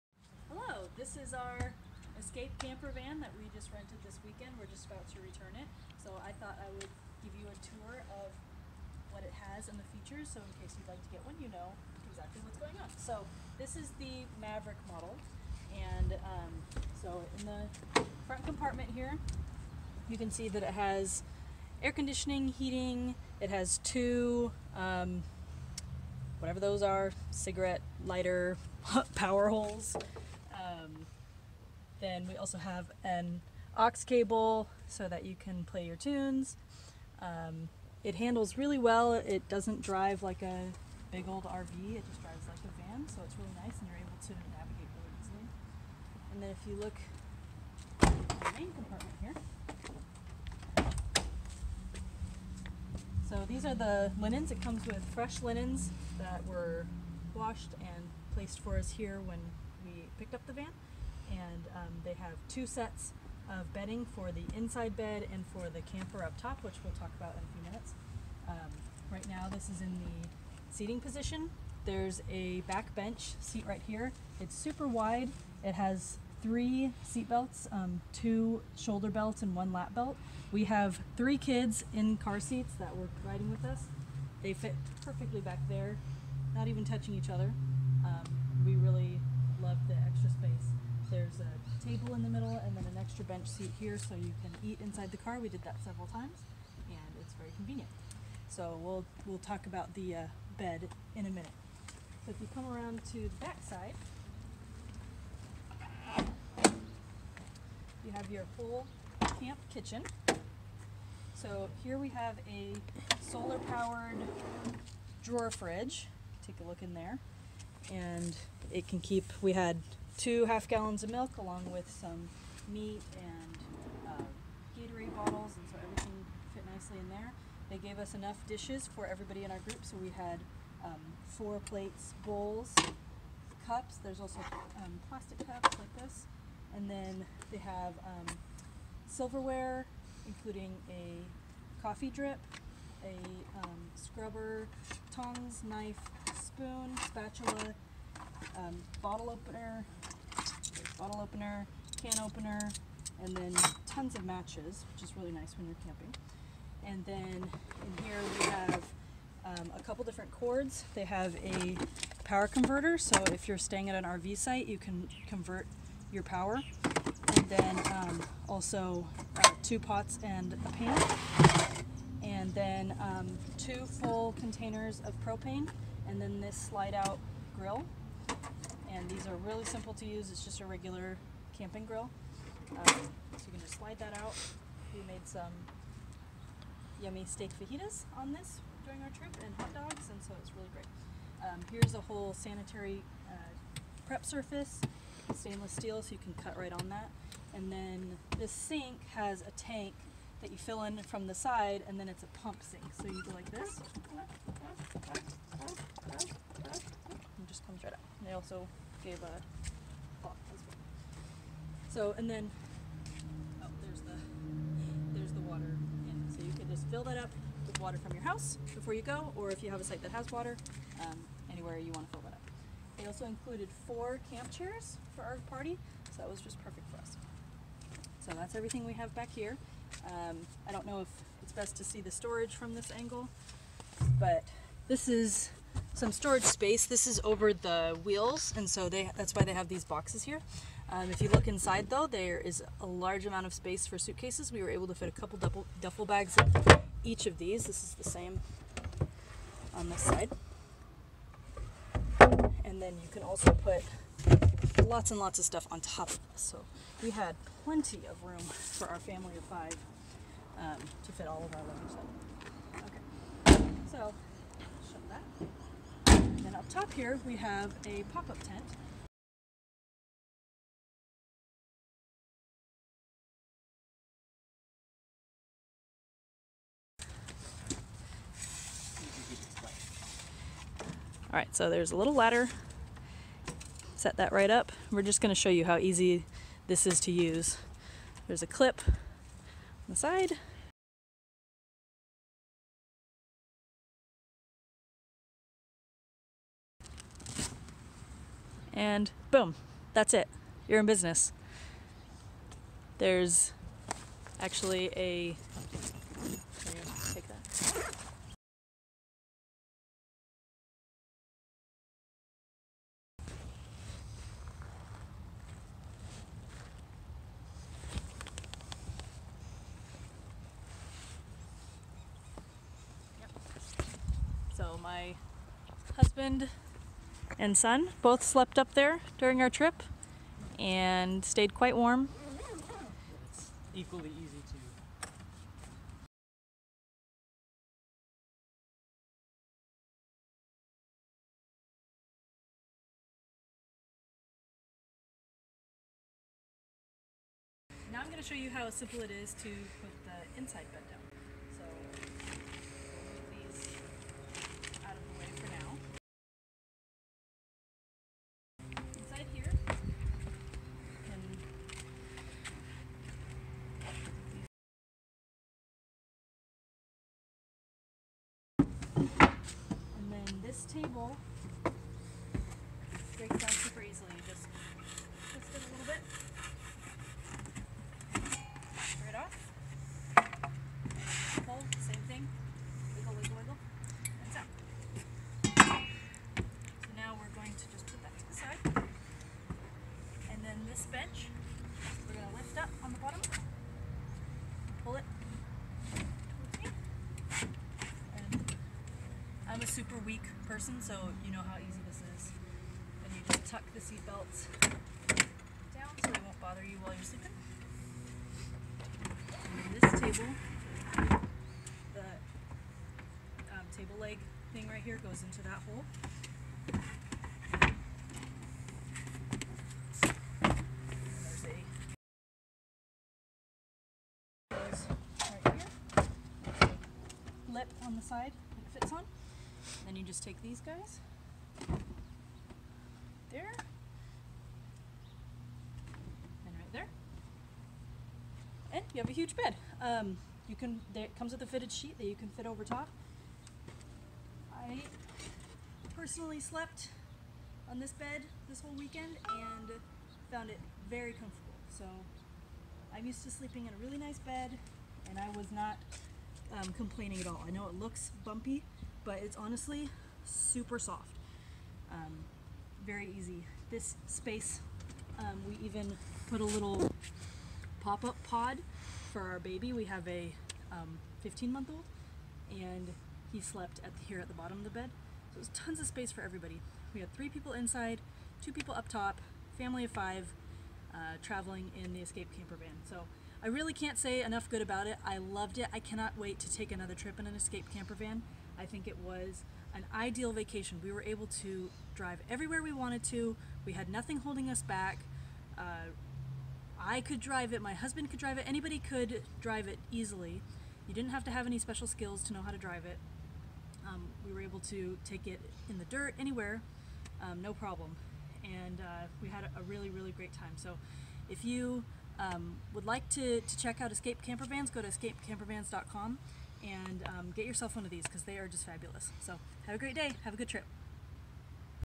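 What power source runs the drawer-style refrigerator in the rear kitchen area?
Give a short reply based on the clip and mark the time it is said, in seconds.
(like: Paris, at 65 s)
Solar, at 113 s.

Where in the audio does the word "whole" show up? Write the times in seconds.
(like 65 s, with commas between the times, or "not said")
192 s, 448 s.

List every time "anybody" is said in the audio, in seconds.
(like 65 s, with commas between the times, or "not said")
498 s.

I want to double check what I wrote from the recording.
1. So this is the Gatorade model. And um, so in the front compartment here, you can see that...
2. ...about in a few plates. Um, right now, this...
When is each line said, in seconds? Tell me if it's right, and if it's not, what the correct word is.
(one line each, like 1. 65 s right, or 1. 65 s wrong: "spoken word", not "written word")
1. 12 s wrong: "Maverick", not "Gatorade"
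2. 67 s wrong: "minutes", not "plates".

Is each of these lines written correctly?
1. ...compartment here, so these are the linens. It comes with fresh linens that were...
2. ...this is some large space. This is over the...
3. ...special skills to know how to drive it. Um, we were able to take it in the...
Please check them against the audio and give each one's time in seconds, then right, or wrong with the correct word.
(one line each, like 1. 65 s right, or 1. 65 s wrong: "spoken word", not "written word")
1. 48 s right
2. 234 s wrong: "storage", not "large"
3. 501 s right.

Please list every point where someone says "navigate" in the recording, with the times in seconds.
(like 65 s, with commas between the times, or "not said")
44 s.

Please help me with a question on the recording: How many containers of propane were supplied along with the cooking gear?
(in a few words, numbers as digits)
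2.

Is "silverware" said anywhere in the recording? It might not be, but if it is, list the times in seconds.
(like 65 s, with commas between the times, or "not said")
139 s.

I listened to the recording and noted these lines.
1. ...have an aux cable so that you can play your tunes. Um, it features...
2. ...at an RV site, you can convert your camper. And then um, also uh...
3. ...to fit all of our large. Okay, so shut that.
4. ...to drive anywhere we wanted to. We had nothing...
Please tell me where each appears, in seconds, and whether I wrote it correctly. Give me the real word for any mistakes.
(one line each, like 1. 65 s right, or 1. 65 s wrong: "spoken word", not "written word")
1. 32 s wrong: "handles", not "features"
2. 163 s wrong: "power", not "camper"
3. 261 s wrong: "luggage", not "large"
4. 491 s wrong: "everywhere", not "anywhere".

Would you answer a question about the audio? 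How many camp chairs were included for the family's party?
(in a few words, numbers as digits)
4.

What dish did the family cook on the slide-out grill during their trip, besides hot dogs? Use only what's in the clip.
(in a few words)
Steak fajitas.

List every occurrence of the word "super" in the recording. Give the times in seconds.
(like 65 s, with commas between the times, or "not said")
74 s, 373 s, 399 s, 460 s.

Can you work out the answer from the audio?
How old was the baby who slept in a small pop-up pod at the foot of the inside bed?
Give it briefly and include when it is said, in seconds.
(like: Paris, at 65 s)
15 months, at 471 s.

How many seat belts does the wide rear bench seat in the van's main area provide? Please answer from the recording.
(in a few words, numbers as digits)
3.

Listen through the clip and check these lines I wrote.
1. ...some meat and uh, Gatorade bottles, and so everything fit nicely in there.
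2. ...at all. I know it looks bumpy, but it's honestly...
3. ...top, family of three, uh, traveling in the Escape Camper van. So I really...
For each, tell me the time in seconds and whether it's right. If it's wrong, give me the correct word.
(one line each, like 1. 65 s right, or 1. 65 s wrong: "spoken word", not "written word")
1. 121 s right
2. 457 s right
3. 478 s wrong: "five", not "three".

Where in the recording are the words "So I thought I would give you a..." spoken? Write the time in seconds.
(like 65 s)
6 s.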